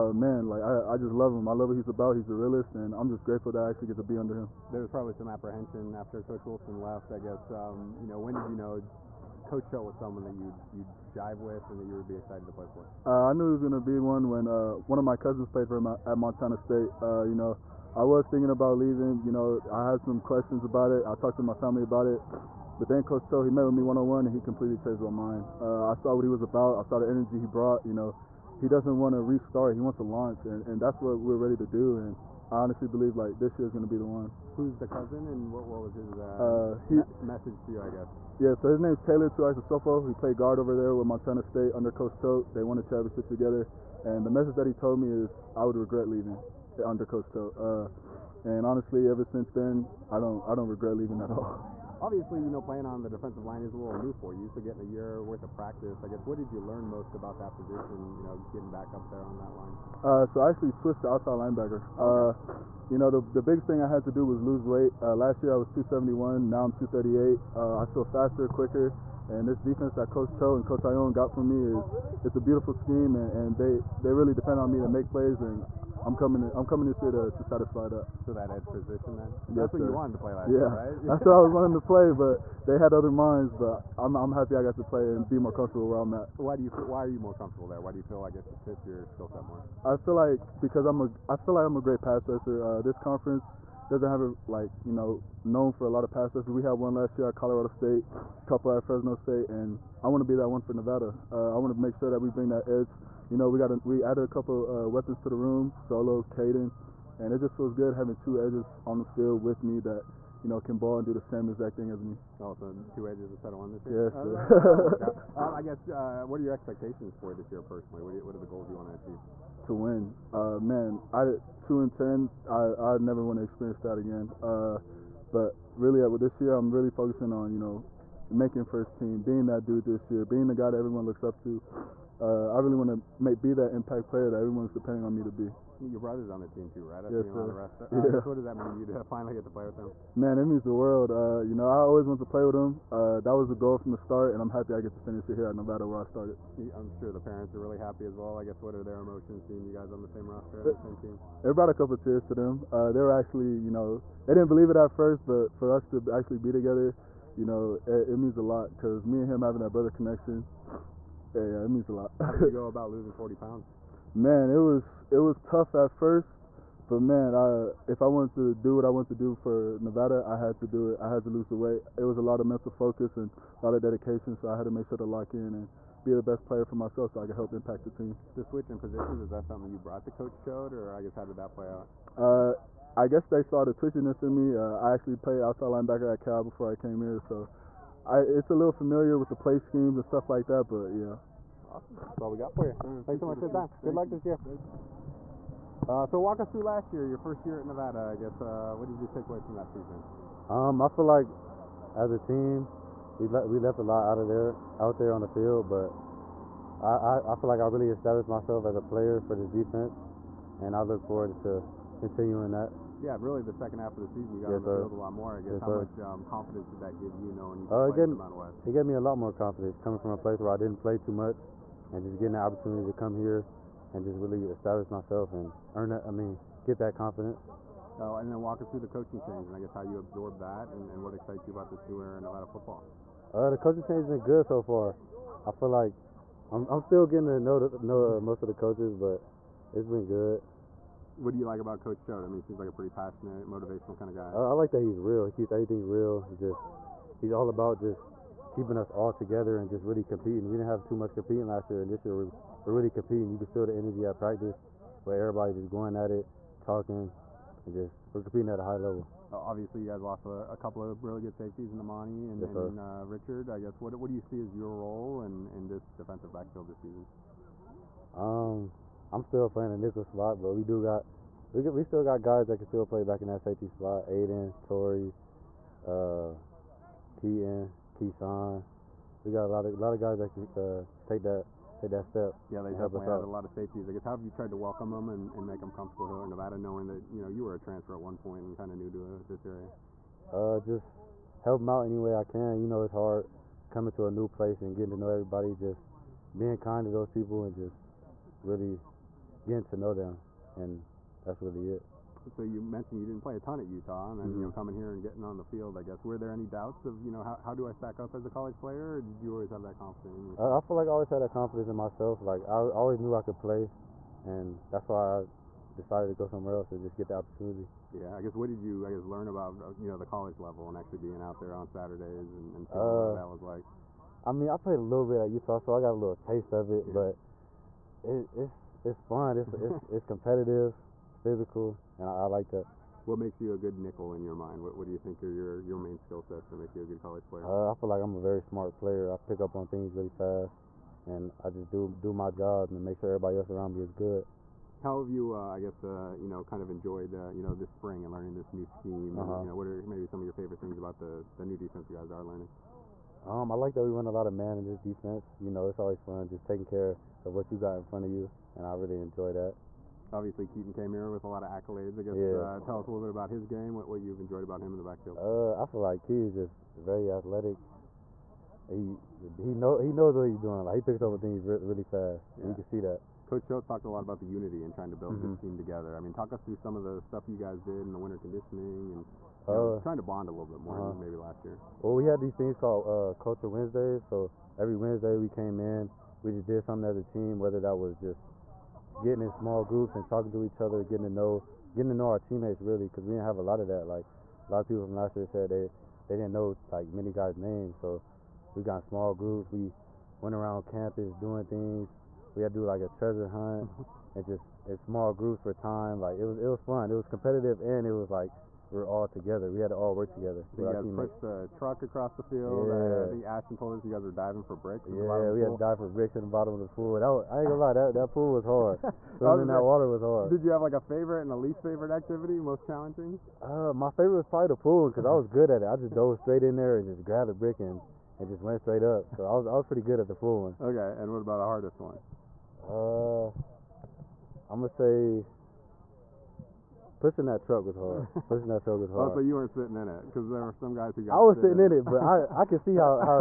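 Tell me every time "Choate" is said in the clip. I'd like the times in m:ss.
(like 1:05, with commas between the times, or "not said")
0:23, 0:42, 0:47, 1:10, 4:02.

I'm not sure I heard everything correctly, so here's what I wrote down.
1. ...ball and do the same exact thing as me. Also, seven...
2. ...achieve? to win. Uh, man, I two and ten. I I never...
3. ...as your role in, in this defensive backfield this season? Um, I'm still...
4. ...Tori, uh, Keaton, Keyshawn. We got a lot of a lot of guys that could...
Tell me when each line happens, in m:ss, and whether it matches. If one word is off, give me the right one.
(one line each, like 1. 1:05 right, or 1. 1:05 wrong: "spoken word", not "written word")
1. 1:50 wrong: "two", not "seven"
2. 1:58 right
3. 4:24 right
4. 4:34 right.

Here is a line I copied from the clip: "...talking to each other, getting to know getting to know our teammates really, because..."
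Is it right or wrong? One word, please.
right.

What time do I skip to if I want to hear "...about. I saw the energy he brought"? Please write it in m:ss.
0:26.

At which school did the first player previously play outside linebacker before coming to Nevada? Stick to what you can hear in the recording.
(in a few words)
Cal.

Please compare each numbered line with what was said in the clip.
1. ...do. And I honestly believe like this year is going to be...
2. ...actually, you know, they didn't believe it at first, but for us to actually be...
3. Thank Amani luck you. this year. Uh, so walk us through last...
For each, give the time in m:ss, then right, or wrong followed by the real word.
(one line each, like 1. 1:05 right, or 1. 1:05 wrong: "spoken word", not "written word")
1. 0:31 right
2. 2:33 right
3. 3:13 wrong: "Good", not "Amani".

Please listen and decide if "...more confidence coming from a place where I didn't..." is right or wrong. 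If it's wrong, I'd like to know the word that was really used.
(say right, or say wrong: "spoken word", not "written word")
right.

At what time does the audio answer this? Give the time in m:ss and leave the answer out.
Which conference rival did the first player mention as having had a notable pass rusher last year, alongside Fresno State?
1:37.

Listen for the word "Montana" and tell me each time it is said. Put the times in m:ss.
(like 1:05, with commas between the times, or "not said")
0:16, 0:41.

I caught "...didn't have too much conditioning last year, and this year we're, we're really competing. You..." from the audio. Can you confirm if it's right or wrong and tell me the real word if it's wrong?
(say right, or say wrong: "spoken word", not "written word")
wrong: "competing", not "conditioning".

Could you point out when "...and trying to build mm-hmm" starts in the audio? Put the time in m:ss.
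6:14.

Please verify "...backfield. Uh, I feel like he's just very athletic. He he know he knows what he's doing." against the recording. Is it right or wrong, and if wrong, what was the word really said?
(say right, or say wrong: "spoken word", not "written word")
right.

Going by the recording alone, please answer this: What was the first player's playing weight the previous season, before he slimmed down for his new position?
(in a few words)
271.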